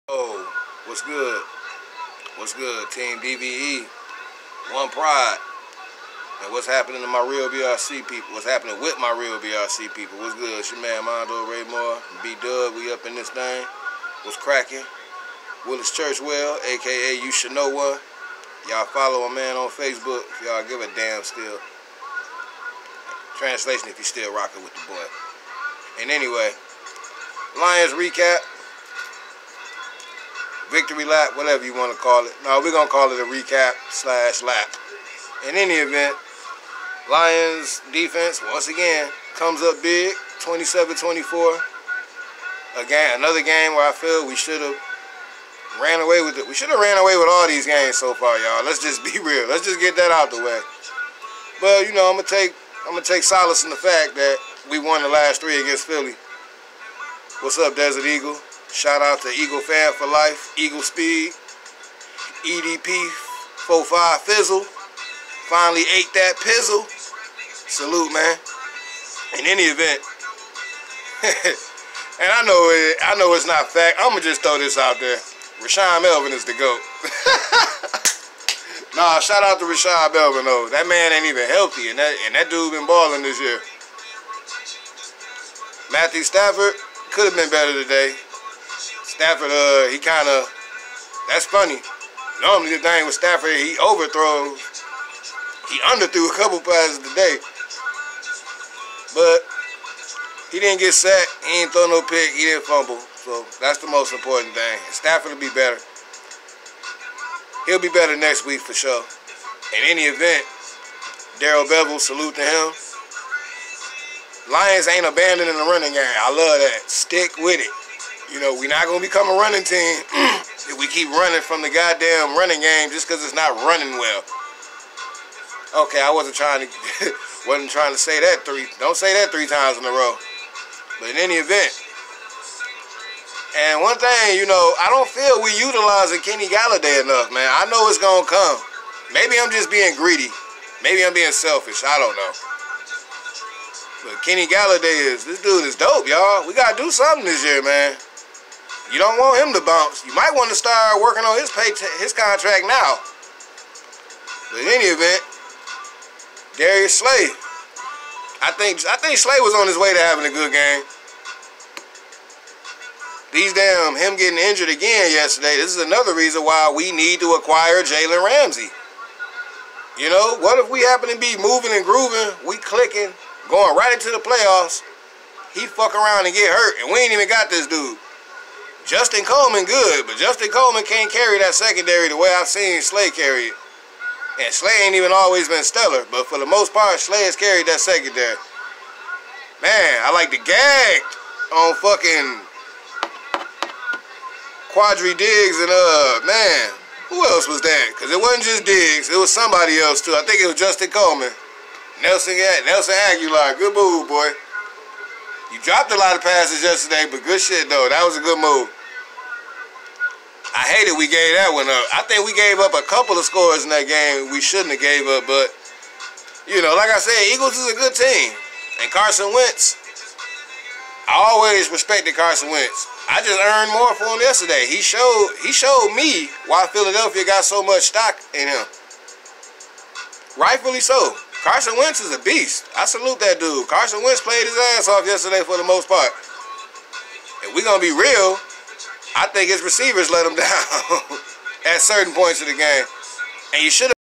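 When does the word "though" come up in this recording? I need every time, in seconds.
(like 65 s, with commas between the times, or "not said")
80 s, 207 s.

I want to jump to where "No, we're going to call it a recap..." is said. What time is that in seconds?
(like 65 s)
32 s.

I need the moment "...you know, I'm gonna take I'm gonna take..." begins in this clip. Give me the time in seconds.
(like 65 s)
51 s.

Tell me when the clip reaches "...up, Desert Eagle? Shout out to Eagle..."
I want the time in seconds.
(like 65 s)
57 s.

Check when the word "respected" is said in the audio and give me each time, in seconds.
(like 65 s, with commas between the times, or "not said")
221 s.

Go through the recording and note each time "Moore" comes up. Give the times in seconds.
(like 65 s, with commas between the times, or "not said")
11 s.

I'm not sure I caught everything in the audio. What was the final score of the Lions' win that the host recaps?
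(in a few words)
27-24.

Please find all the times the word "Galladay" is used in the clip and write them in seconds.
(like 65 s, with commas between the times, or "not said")
136 s, 144 s.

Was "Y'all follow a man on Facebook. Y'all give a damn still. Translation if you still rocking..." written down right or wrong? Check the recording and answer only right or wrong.
right.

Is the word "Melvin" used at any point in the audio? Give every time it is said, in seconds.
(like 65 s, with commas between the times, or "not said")
76 s, 80 s.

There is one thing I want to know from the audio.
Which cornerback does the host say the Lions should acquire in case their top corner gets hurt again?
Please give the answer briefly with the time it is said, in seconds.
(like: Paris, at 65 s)
Jalen Ramsey, at 167 s.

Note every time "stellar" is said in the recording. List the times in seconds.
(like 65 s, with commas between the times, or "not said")
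185 s.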